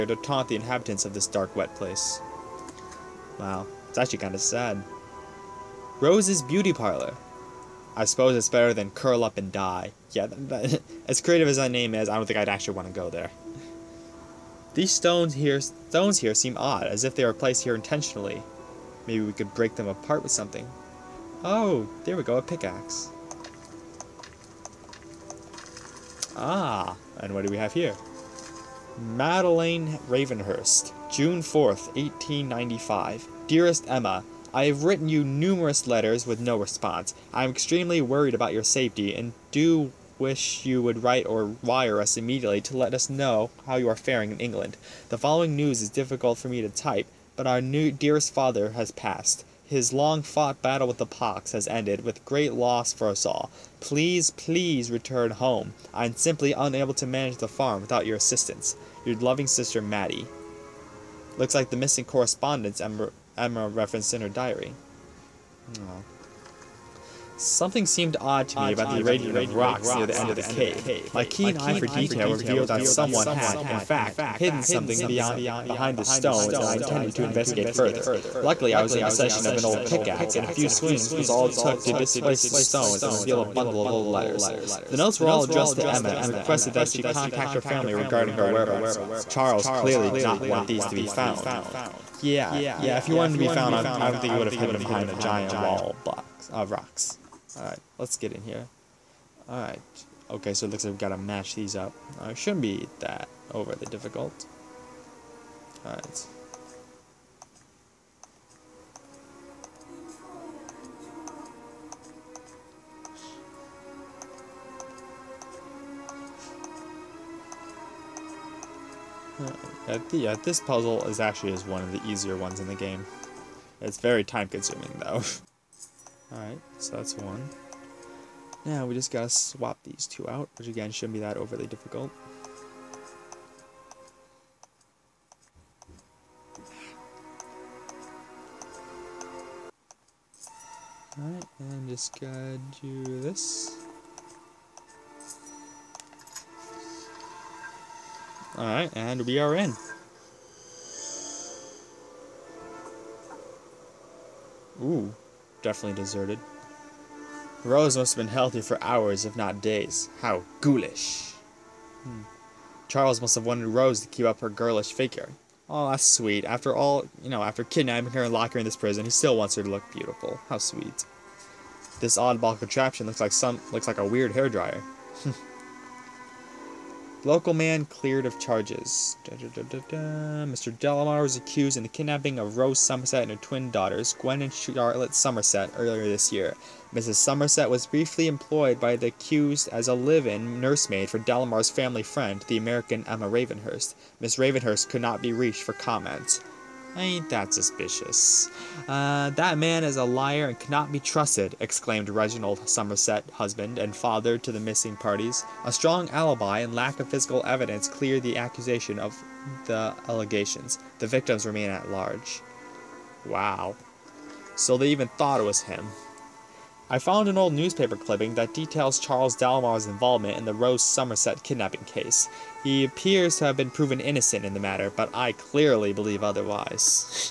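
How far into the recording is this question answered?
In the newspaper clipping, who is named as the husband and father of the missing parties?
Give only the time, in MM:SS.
03:22.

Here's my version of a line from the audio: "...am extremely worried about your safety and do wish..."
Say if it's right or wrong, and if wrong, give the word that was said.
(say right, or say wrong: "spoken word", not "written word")
right.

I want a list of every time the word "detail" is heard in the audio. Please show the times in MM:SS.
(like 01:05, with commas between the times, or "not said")
01:11, 03:38.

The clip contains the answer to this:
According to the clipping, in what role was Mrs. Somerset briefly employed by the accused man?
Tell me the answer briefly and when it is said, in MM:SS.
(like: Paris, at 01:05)
Live-in nursemaid, at 03:09.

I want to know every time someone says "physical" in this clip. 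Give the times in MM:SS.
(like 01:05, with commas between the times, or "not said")
03:27.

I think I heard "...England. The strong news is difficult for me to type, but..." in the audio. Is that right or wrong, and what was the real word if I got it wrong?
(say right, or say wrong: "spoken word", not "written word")
wrong: "following", not "strong".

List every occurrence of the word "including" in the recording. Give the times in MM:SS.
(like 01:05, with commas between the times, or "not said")
not said.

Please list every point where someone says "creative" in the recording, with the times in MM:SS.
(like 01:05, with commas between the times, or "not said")
00:11.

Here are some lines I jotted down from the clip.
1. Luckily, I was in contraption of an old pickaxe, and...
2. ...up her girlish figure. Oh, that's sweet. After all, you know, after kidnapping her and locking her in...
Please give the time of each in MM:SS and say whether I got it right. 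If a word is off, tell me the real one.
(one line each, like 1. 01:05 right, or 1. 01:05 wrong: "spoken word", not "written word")
1. 01:18 wrong: "possession", not "contraption"
2. 02:44 right.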